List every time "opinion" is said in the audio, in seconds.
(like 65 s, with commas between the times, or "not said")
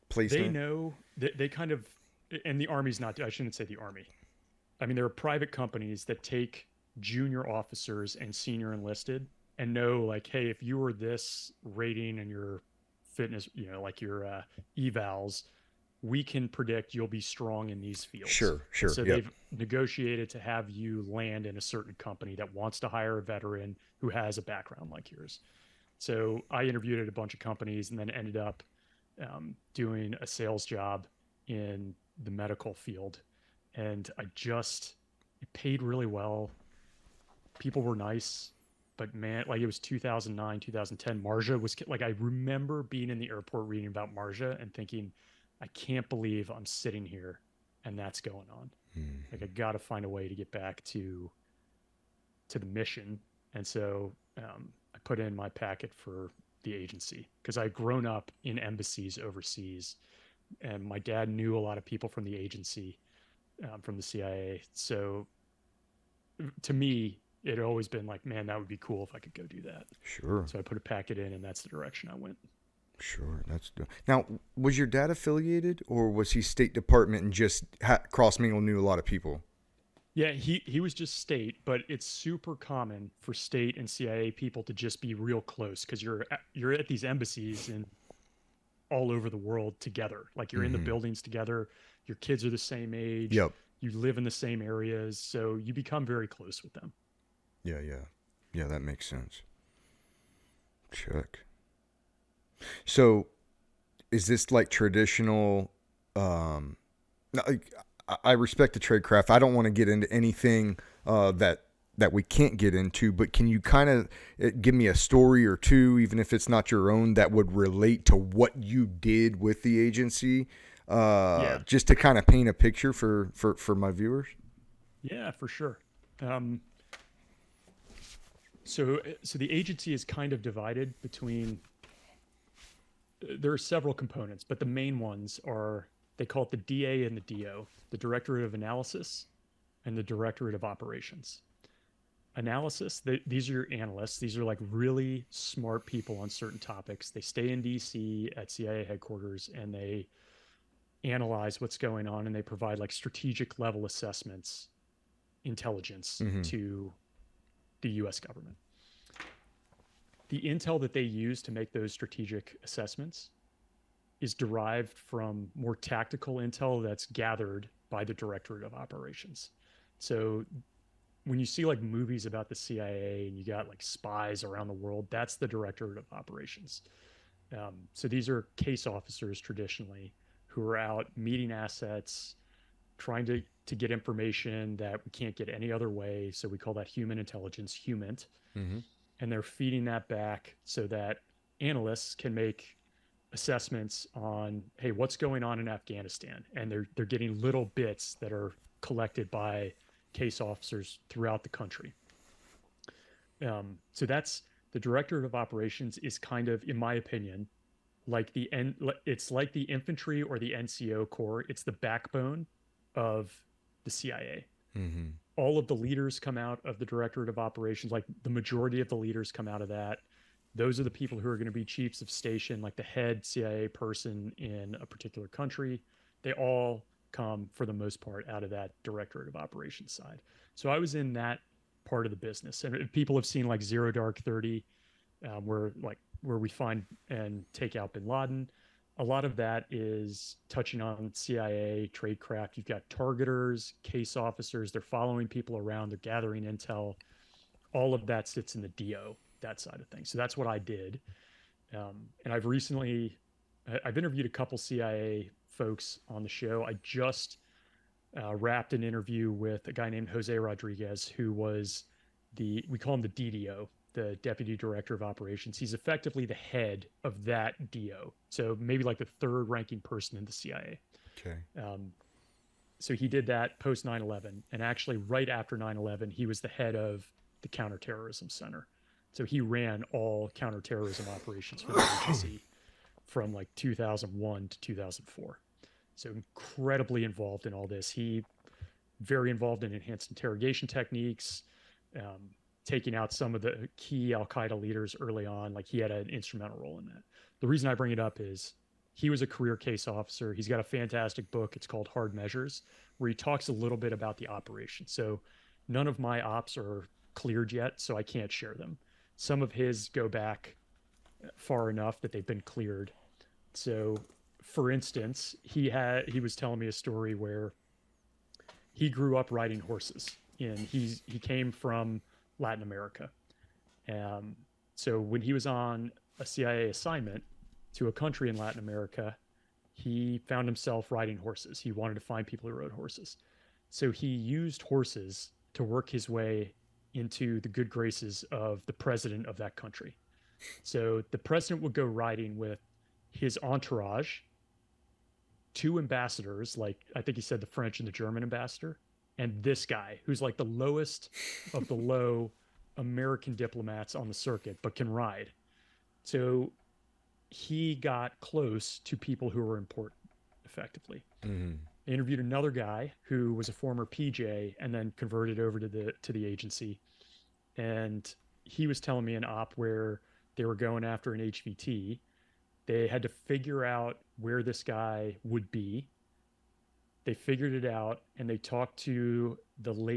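206 s.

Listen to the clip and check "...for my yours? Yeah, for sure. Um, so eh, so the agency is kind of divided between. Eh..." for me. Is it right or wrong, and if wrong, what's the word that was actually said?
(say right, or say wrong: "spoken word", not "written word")
wrong: "viewers", not "yours".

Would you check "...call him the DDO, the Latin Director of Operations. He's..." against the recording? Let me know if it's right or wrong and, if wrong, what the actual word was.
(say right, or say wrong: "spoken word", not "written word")
wrong: "Deputy", not "Latin".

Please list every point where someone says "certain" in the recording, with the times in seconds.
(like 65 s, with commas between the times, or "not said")
21 s, 146 s.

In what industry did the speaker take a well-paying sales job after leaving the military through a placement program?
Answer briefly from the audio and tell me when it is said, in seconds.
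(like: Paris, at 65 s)
Medical field, at 32 s.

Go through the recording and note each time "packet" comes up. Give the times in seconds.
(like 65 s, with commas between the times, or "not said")
55 s, 70 s.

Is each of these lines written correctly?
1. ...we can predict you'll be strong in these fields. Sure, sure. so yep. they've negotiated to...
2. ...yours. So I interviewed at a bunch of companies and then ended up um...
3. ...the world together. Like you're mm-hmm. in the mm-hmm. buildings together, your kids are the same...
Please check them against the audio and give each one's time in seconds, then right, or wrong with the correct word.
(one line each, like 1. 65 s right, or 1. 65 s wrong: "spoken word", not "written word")
1. 16 s right
2. 25 s right
3. 89 s right.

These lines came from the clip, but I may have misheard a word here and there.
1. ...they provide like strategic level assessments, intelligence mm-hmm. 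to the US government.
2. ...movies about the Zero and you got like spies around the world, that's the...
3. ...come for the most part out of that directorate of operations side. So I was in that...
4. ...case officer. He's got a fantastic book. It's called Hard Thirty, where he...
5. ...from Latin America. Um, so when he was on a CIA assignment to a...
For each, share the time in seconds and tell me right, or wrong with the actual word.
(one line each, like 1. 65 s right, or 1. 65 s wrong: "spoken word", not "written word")
1. 152 s right
2. 171 s wrong: "CIA", not "Zero"
3. 227 s right
4. 299 s wrong: "Measures", not "Thirty"
5. 321 s right.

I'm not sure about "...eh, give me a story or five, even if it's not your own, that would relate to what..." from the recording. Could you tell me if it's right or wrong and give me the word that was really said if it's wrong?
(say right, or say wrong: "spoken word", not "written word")
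wrong: "two", not "five".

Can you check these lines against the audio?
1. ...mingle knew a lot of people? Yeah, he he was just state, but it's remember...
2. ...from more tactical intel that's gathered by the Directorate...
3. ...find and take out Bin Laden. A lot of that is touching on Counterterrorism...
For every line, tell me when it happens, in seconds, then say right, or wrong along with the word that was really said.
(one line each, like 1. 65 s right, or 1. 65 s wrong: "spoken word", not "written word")
1. 78 s wrong: "super", not "remember"
2. 164 s right
3. 236 s wrong: "CIA", not "Counterterrorism".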